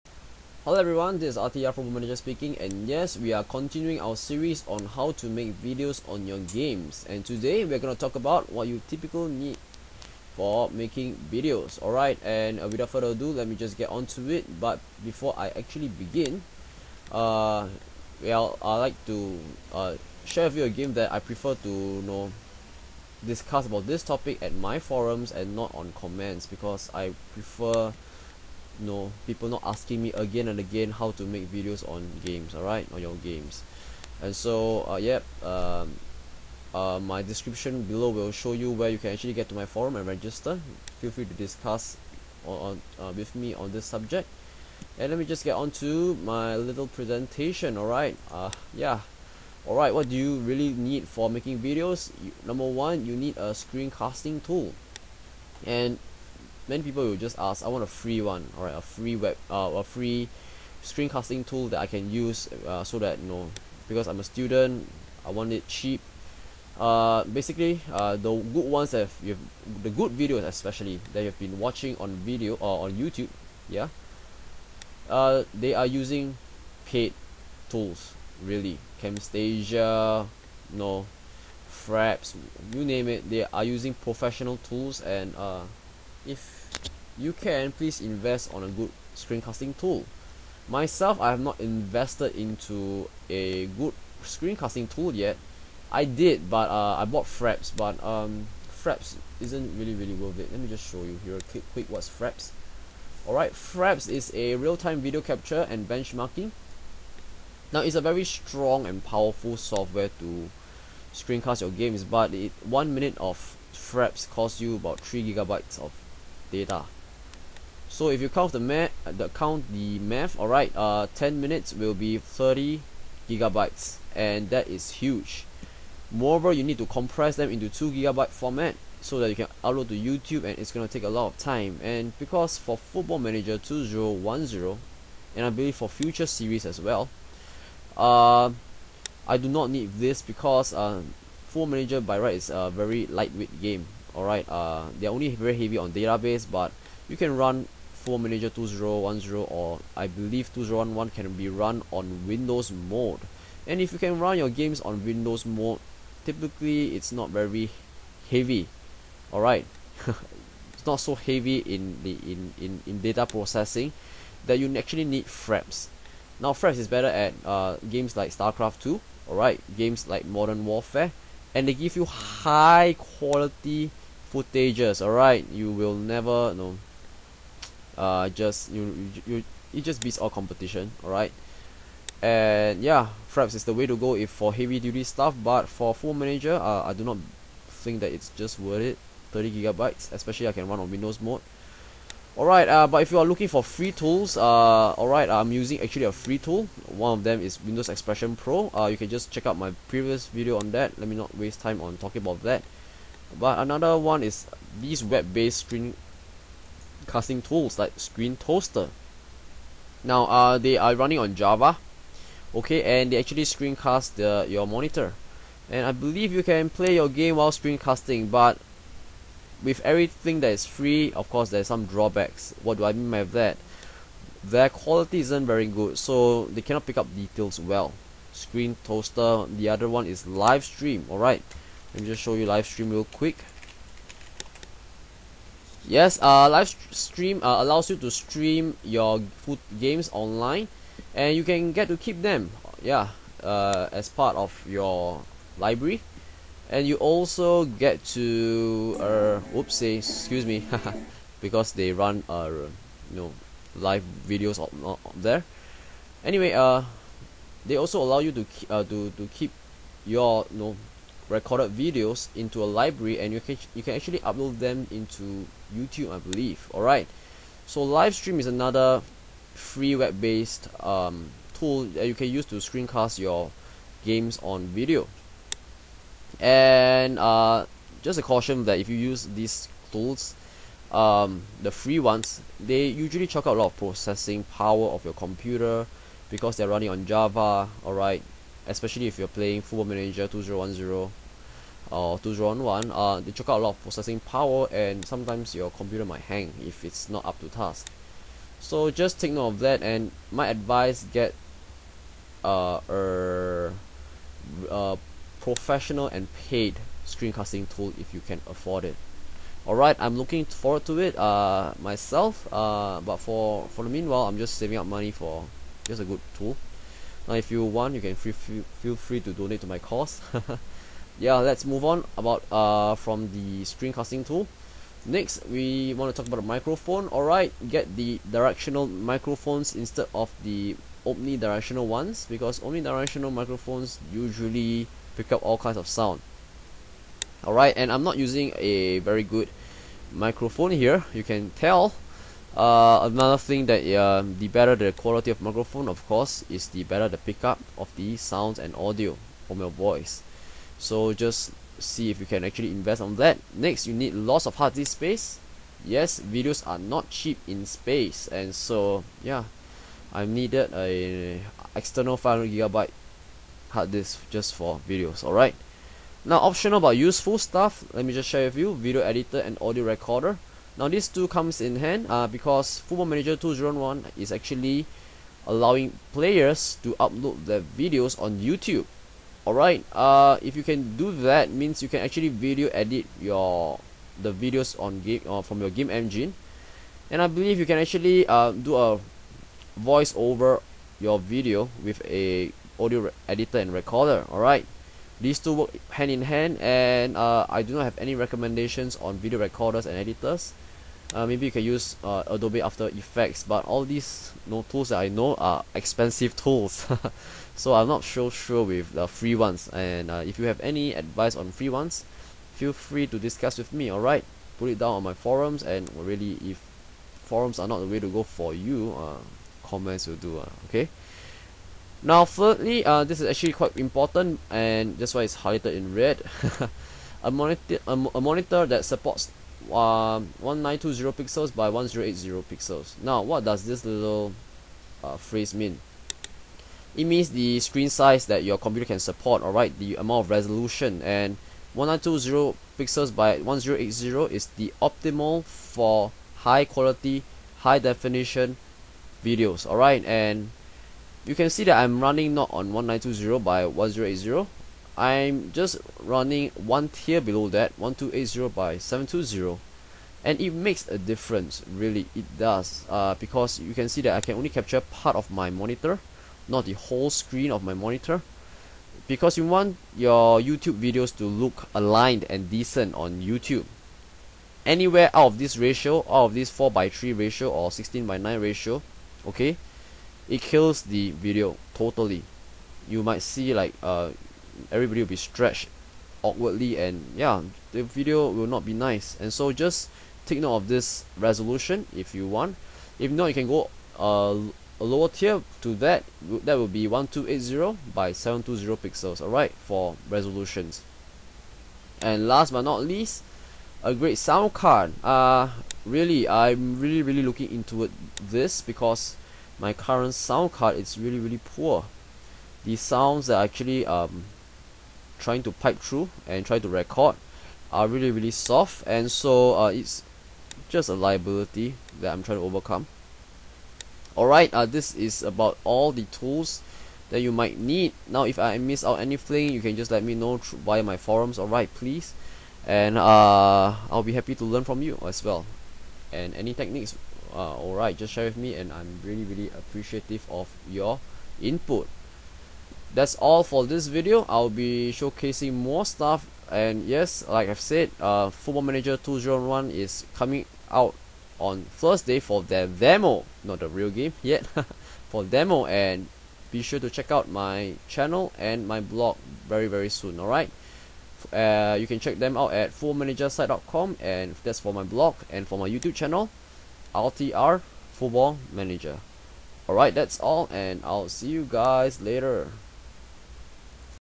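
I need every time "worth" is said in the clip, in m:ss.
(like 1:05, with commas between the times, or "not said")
1:40, 3:08.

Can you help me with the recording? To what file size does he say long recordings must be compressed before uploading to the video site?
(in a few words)
2 gigabyte.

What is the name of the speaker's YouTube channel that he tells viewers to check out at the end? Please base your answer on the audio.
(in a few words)
RTR Football Manager.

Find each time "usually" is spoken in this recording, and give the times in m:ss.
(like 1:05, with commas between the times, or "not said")
4:42, 5:34.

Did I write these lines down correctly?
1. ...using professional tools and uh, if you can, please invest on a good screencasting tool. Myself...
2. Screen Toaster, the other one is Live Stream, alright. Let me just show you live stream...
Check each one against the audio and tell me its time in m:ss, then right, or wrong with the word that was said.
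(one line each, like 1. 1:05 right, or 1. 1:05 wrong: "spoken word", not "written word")
1. 1:23 right
2. 3:48 right.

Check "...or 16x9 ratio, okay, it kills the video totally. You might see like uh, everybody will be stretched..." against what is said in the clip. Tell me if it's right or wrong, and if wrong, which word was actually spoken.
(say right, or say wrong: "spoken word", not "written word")
right.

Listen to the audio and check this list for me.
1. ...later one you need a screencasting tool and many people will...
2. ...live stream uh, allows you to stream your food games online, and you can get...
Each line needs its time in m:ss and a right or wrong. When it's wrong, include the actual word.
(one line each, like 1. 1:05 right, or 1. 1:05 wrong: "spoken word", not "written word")
1. 0:52 wrong: "number", not "later"
2. 3:56 right.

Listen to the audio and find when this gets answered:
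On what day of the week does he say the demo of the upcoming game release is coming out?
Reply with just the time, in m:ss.
9:11.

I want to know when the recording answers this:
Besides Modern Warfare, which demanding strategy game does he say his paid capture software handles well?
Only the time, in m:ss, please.
2:48.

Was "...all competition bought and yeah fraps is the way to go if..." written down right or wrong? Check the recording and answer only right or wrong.
wrong.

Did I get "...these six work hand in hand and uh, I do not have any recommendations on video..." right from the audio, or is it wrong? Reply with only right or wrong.
wrong.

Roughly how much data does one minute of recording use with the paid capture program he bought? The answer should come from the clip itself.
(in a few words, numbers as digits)
3 gigabytes.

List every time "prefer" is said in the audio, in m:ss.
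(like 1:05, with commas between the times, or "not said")
0:21, 0:27.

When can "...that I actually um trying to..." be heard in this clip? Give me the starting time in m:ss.
8:33.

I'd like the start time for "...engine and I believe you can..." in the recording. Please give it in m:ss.
6:25.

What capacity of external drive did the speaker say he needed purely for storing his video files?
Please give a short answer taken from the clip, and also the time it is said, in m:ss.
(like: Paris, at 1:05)
500 gigabyte, at 6:02.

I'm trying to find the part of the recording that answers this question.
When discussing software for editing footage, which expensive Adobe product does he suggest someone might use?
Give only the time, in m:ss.
6:42.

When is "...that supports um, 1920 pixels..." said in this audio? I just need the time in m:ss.
7:08.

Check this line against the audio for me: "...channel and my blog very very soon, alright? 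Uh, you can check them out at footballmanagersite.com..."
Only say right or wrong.
right.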